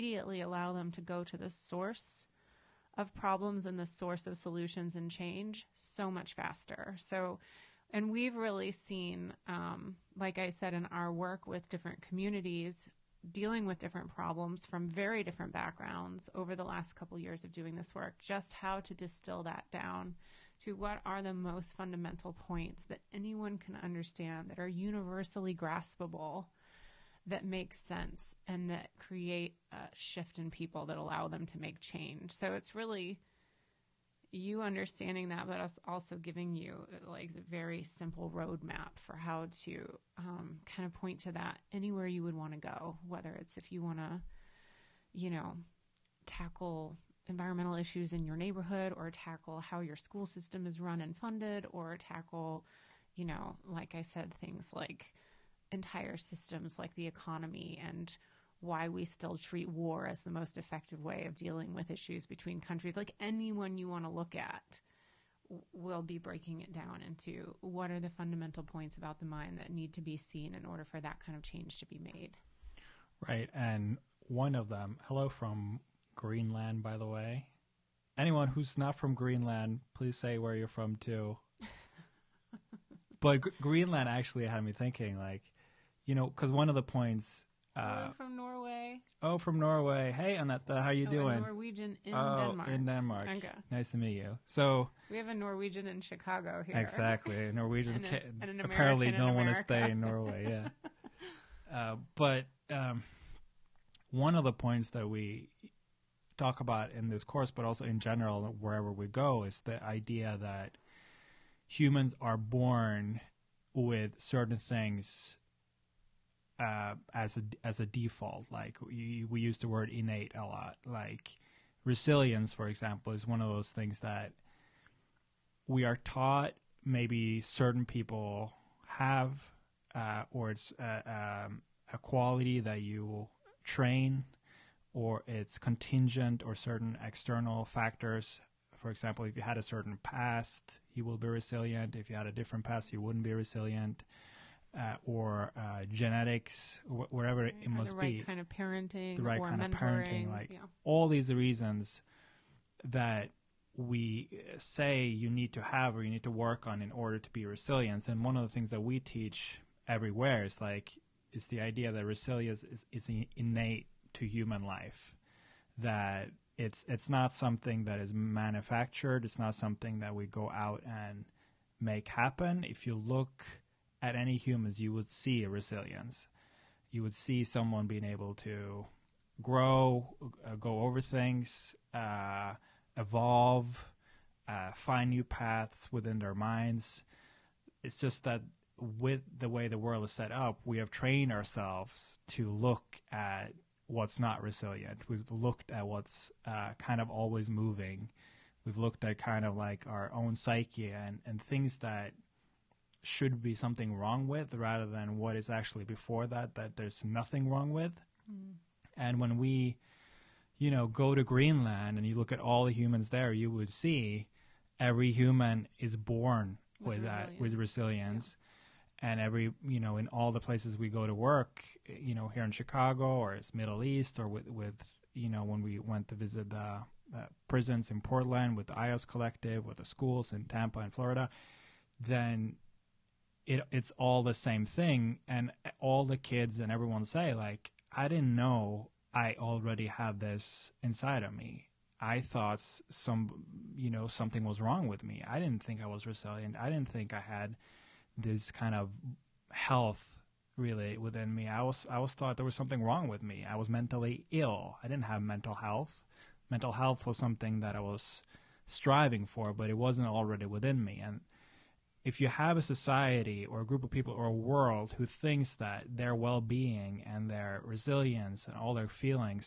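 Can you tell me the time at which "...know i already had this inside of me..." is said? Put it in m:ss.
3:58.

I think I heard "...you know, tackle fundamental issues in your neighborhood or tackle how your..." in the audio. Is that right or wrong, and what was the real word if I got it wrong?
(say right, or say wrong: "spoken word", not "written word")
wrong: "environmental", not "fundamental".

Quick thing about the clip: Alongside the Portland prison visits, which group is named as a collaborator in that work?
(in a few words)
IOS Collective.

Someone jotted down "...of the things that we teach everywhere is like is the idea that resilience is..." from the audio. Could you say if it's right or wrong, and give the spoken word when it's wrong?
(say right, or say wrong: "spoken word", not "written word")
right.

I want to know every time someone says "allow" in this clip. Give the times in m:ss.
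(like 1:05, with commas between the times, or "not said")
0:00, 0:30.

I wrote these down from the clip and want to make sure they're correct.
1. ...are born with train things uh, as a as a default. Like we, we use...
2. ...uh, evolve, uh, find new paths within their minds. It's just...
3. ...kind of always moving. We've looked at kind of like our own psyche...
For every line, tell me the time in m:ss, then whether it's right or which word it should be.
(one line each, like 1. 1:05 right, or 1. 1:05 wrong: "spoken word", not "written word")
1. 1:52 wrong: "certain", not "train"
2. 3:01 right
3. 3:16 right.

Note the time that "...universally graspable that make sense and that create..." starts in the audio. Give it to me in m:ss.
0:24.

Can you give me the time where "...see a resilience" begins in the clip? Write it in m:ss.
2:55.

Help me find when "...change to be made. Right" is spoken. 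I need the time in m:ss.
1:11.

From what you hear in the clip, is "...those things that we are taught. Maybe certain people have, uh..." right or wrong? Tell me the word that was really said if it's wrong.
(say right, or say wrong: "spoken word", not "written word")
right.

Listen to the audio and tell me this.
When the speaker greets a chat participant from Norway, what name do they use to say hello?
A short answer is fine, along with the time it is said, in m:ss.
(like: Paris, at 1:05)
Anetta, at 1:30.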